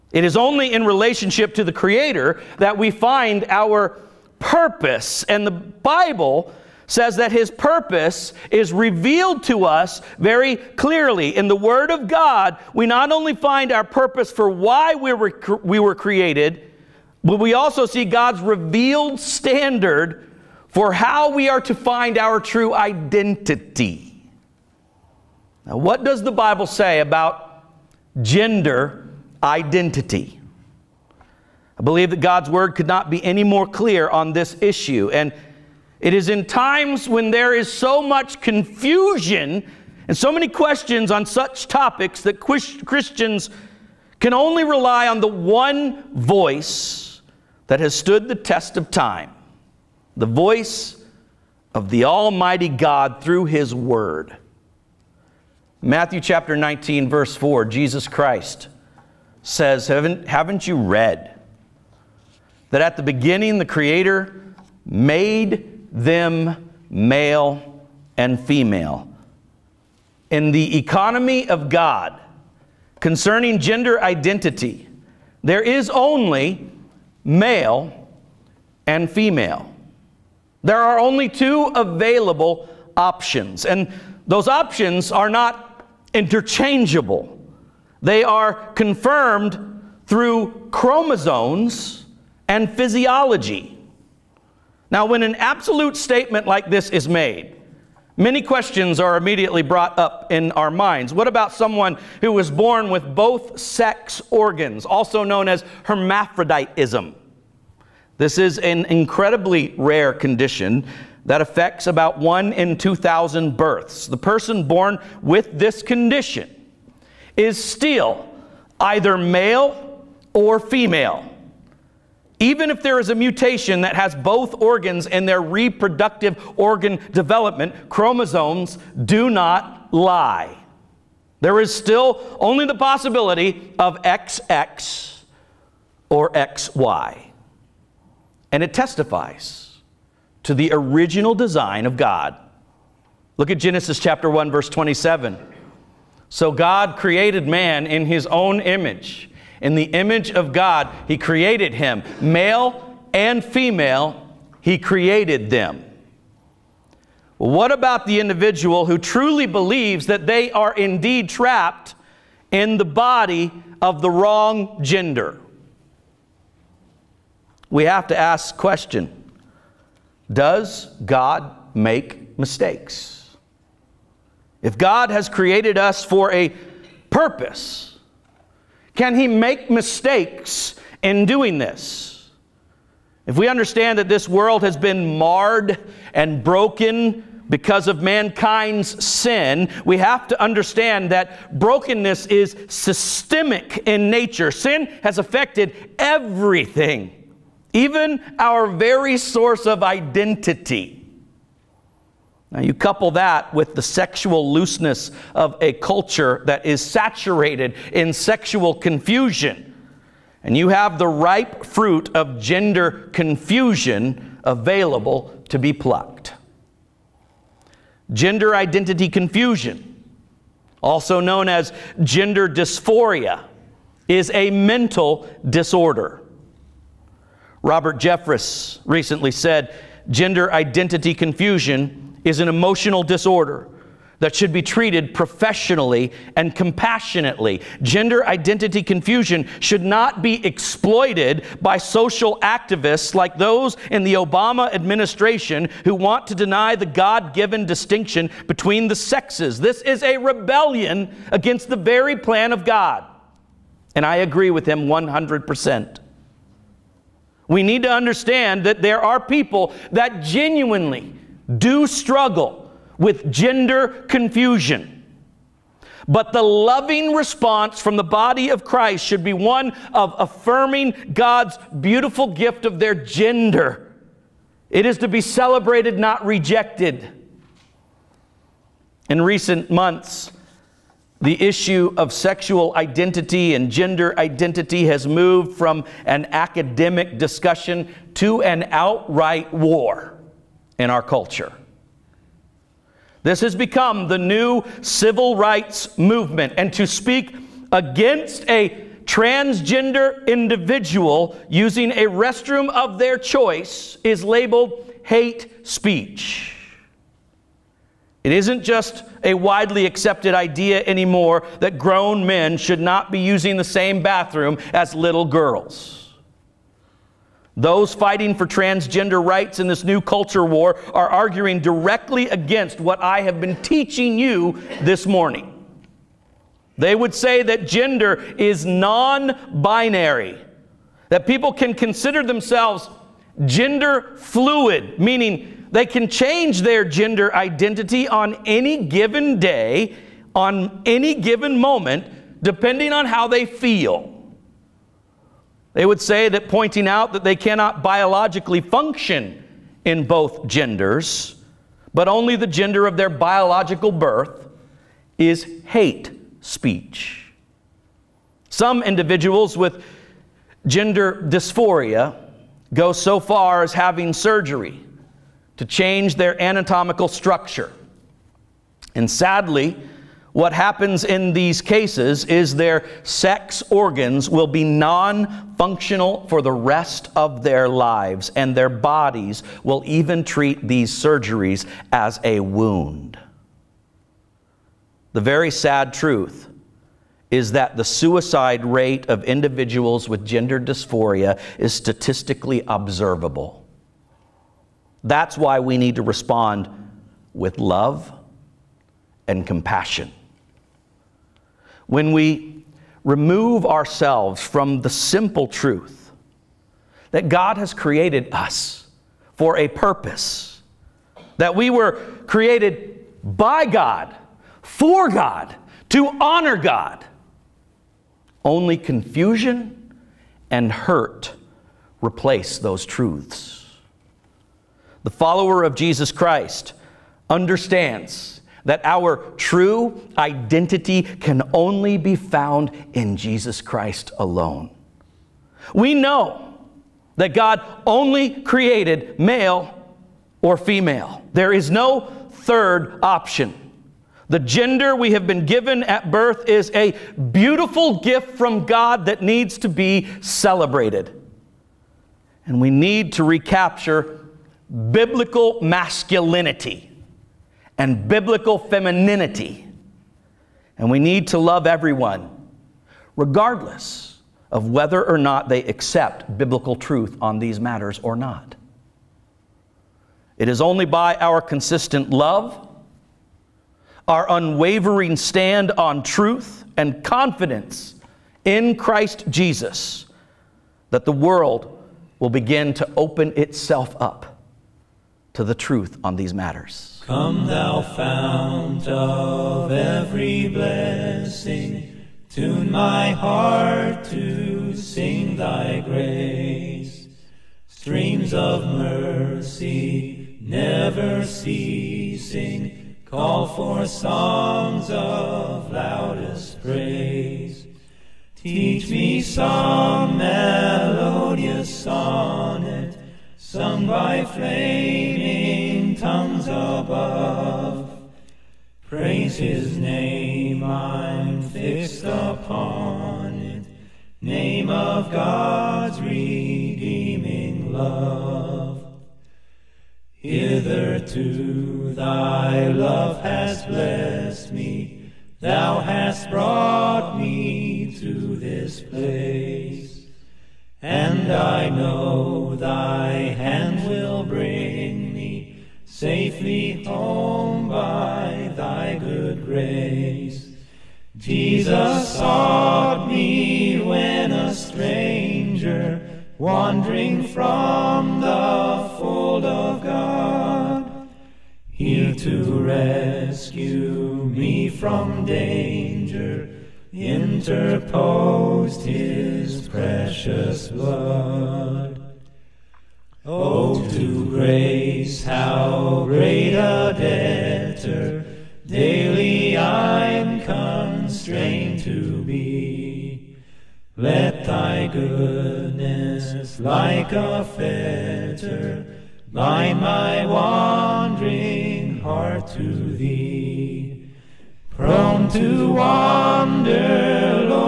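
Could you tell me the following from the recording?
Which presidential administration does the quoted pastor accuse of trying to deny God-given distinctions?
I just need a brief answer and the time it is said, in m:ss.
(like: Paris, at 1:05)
Obama administration, at 4:04.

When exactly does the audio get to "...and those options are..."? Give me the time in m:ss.
1:23.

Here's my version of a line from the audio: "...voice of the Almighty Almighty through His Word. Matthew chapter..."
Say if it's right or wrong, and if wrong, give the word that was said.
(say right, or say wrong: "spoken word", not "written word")
wrong: "God", not "Almighty".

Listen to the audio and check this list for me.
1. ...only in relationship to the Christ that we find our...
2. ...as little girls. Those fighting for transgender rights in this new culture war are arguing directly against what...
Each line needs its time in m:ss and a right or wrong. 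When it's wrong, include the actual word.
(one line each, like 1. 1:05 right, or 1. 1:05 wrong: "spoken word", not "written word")
1. 0:00 wrong: "Creator", not "Christ"
2. 5:14 right.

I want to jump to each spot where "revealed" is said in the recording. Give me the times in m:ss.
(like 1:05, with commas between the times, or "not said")
0:08, 0:18.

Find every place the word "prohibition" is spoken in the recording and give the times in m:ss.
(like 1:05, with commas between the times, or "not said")
not said.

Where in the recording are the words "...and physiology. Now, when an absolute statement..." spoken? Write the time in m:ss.
1:32.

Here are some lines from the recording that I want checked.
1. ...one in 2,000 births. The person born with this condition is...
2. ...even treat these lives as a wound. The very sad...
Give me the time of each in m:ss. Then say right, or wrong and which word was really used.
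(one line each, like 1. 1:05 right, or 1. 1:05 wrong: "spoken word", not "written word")
1. 1:52 right
2. 6:19 wrong: "surgeries", not "lives".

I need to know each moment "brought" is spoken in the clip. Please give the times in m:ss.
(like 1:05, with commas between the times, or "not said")
1:39, 8:56.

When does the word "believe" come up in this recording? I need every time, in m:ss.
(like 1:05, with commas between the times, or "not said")
0:31, 2:39.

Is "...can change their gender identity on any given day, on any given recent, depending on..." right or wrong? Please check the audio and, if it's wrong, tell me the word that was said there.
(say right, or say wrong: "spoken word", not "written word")
wrong: "moment", not "recent".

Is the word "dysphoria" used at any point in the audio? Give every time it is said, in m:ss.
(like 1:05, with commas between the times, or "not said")
3:42, 6:01, 6:30.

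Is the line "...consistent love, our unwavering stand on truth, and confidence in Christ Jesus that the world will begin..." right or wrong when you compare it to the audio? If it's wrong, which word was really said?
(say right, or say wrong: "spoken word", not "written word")
right.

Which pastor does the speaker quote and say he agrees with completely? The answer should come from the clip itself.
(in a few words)
Robert Jeffress.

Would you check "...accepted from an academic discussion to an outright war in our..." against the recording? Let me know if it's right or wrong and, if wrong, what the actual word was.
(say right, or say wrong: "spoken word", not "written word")
wrong: "moved", not "accepted".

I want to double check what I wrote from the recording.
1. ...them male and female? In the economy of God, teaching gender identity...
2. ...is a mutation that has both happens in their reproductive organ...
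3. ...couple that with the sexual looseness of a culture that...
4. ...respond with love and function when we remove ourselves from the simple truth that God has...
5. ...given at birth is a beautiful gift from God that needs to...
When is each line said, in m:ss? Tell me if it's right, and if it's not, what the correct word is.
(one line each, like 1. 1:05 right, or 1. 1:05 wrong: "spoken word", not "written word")
1. 1:05 wrong: "concerning", not "teaching"
2. 2:02 wrong: "organs", not "happens"
3. 3:22 right
4. 6:36 wrong: "compassion", not "function"
5. 7:25 right.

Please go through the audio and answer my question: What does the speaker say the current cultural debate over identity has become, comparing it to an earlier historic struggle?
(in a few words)
New civil rights movement.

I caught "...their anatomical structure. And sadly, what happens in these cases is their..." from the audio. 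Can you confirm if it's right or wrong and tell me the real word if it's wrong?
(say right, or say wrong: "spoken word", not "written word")
right.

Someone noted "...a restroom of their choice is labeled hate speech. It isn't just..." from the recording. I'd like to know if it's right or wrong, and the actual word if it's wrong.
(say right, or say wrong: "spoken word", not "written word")
right.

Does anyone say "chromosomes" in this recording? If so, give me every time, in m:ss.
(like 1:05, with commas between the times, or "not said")
1:30, 2:07.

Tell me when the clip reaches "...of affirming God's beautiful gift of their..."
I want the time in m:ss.
4:29.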